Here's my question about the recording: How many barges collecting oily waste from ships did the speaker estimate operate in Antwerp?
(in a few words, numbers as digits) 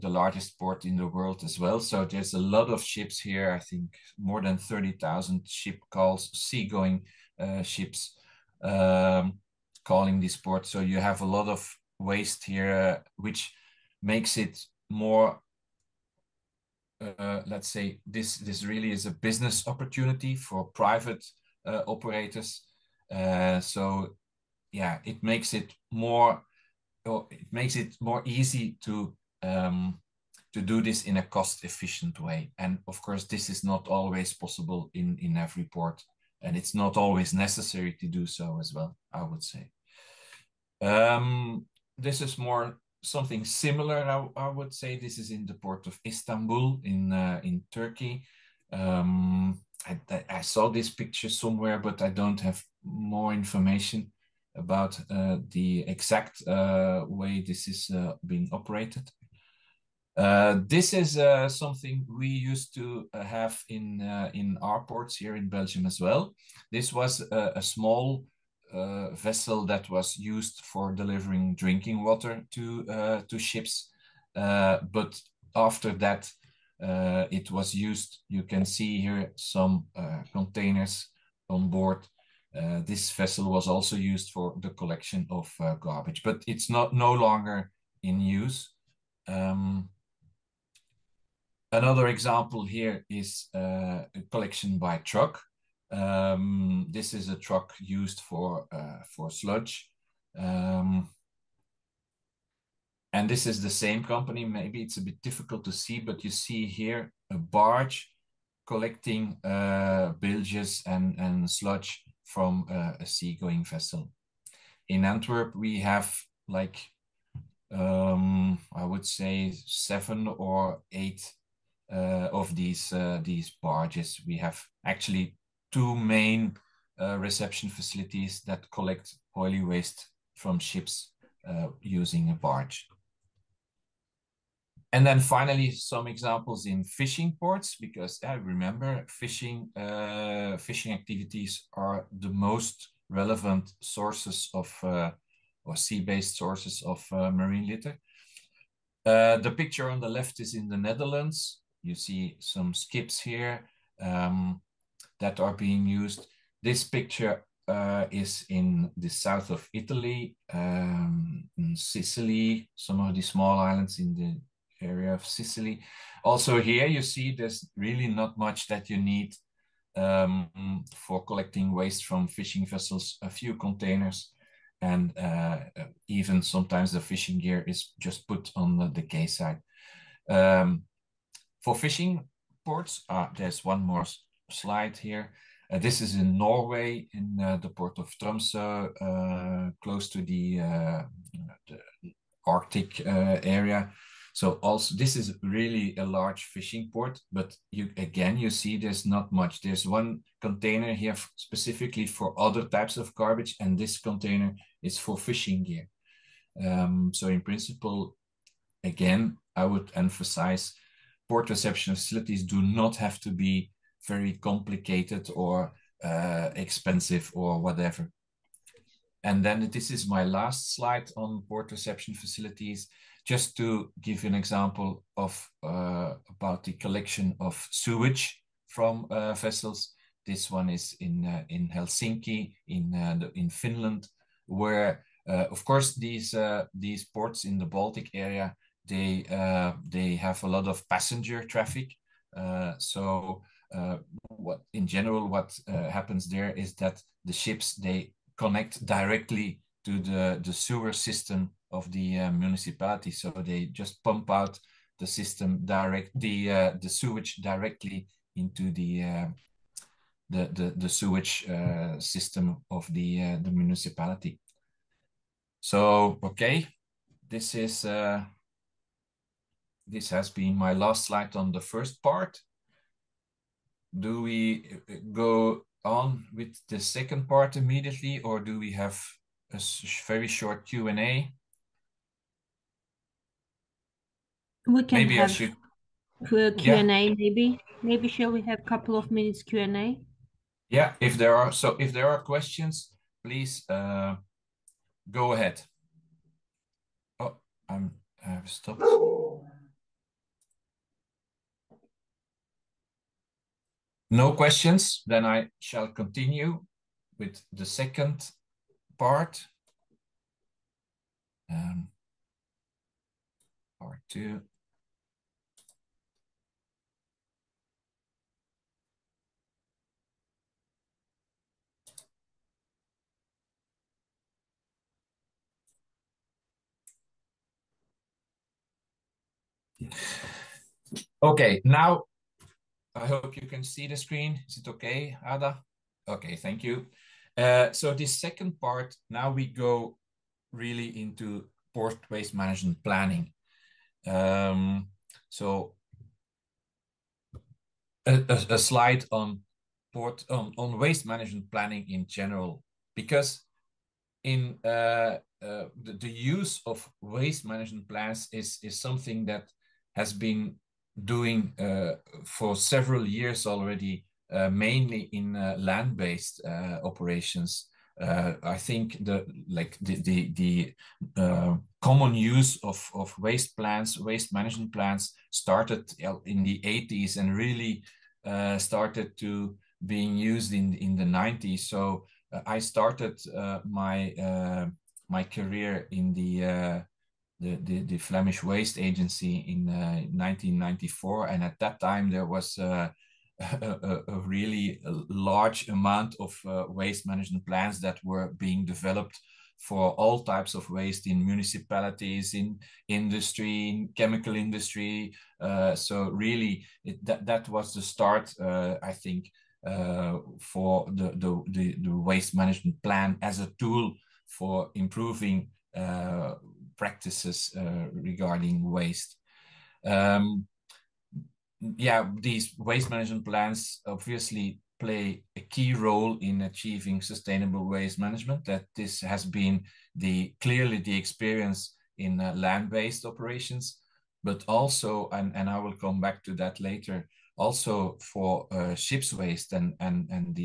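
seven or eight.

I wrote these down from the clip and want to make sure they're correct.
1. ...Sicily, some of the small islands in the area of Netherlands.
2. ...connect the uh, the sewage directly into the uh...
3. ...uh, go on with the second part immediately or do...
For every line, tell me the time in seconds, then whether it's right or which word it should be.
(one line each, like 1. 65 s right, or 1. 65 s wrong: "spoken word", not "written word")
1. 161 s wrong: "Sicily", not "Netherlands"
2. 255 s wrong: "direct", not "connect"
3. 274 s right.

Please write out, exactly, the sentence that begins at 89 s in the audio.
Um, another example here is a collection by truck.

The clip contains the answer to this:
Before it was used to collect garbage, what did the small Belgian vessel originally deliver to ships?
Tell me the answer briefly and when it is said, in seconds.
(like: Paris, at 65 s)
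drinking water, at 71 s.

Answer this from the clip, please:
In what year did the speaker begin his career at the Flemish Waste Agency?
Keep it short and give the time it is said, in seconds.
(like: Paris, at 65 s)
1994, at 389 s.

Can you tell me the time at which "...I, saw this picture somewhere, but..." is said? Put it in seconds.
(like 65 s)
50 s.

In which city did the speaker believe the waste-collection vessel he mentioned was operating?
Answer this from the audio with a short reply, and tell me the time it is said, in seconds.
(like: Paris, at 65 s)
Istanbul, at 46 s.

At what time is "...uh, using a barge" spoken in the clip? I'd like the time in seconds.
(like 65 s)
131 s.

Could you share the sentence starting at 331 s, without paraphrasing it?
Okay, now I hope you can see the screen.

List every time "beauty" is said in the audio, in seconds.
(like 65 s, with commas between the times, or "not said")
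not said.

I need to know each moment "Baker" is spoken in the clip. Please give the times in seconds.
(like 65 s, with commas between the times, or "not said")
not said.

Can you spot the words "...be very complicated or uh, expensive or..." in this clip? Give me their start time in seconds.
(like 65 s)
213 s.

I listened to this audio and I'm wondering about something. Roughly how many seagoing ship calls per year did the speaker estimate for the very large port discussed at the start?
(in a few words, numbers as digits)
more than 30,000.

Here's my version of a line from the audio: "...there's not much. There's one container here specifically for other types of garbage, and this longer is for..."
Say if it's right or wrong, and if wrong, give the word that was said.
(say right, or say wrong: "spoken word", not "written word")
wrong: "container", not "longer".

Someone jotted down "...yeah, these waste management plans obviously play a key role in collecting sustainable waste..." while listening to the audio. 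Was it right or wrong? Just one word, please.
wrong.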